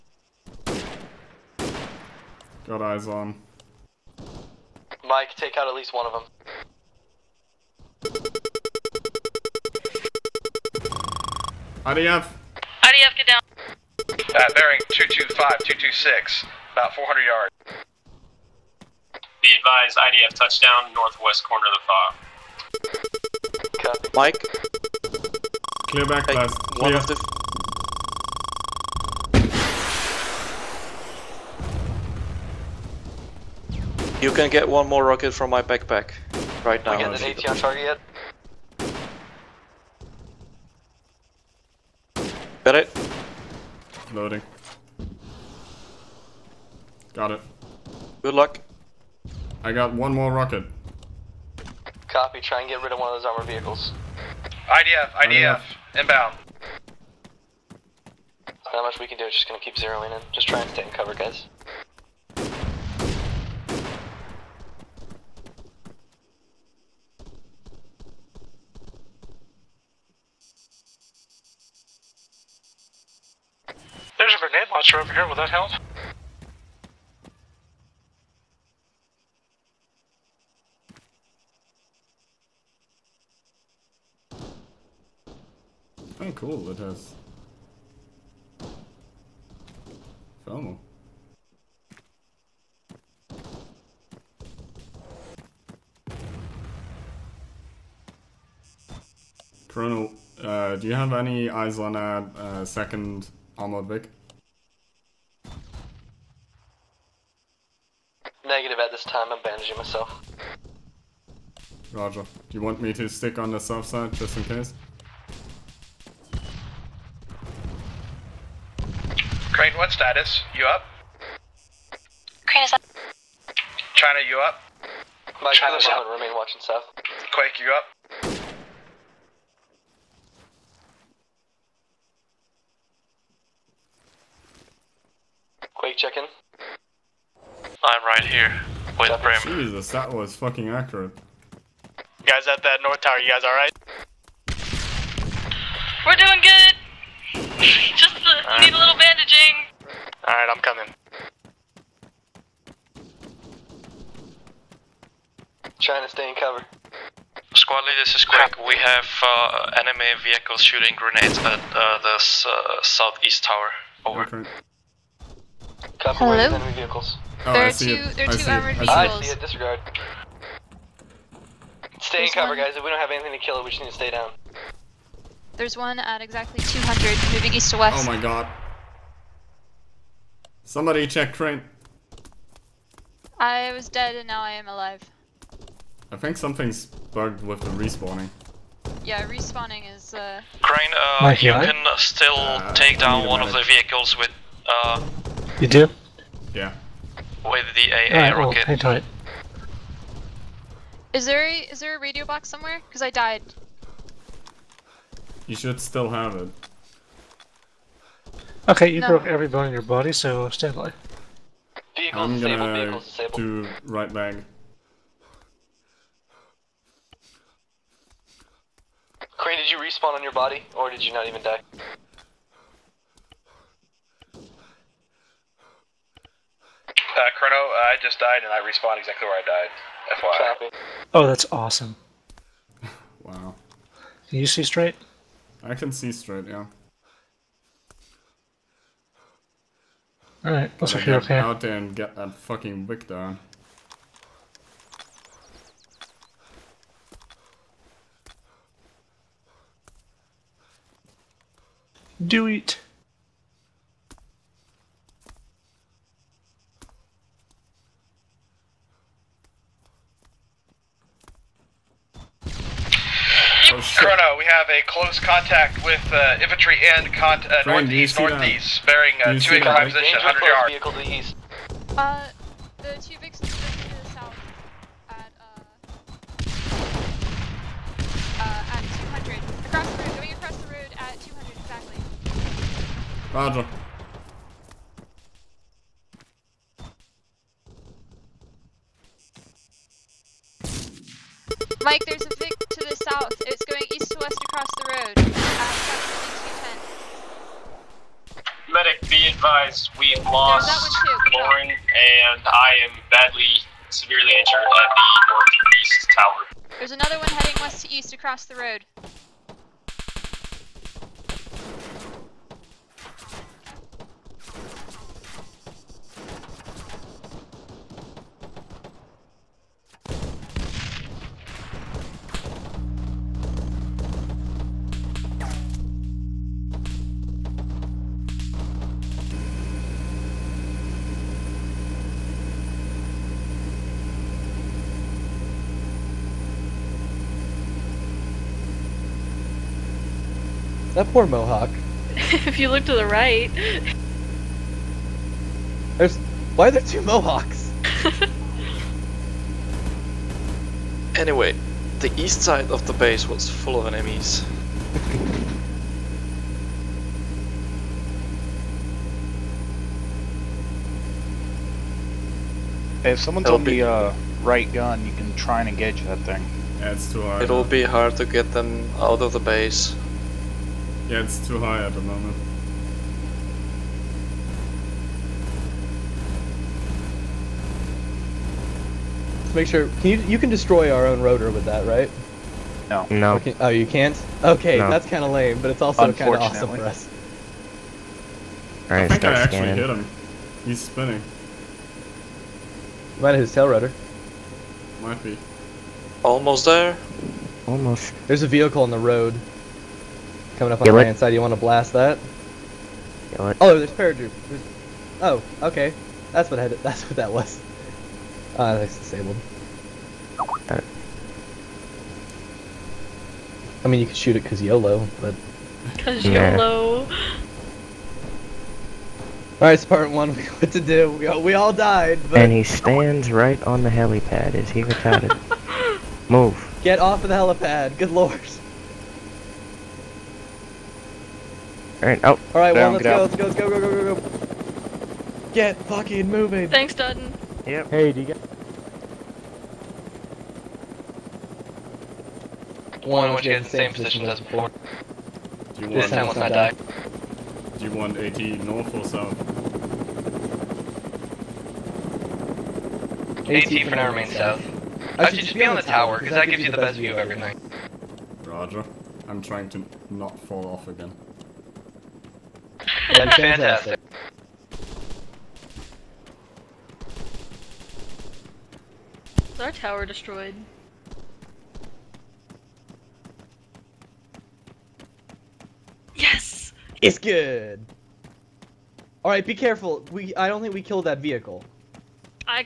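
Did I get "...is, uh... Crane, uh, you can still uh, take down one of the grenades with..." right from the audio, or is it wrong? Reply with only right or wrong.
wrong.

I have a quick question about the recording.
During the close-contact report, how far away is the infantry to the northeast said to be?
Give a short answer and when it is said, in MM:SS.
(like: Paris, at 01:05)
100 yards, at 04:30.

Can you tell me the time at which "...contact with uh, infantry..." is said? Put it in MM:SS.
04:25.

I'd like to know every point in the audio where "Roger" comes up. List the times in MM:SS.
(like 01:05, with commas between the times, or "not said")
01:51, 04:43, 07:38.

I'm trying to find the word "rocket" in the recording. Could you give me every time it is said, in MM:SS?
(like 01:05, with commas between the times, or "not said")
00:35, 00:50, 03:18.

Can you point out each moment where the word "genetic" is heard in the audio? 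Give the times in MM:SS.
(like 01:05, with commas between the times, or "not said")
not said.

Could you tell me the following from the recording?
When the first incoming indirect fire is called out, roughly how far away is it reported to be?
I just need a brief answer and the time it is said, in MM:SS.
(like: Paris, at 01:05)
400 yards, at 00:16.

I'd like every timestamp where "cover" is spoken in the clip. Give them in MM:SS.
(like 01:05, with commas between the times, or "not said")
01:00, 02:36, 02:52.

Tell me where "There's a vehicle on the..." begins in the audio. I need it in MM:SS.
06:38.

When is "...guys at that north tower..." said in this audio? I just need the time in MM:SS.
02:22.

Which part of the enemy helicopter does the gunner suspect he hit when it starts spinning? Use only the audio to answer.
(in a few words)
tail rudder.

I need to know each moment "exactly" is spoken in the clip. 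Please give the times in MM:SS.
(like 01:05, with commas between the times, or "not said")
02:56, 03:48, 04:42.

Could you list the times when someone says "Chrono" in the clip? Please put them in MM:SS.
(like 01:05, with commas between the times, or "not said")
03:47, 04:23.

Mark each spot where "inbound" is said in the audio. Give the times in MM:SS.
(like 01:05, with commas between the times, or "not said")
00:55.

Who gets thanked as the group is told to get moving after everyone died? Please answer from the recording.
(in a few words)
Dutton.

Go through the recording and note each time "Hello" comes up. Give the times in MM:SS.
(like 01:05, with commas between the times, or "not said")
02:45.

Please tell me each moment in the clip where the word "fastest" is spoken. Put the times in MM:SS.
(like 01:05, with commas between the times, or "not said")
not said.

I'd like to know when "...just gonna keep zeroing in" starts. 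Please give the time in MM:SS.
00:59.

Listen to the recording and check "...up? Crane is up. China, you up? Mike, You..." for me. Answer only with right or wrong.
wrong.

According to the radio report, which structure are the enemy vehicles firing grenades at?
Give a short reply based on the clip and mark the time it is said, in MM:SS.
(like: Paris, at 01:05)
southeast tower, at 02:42.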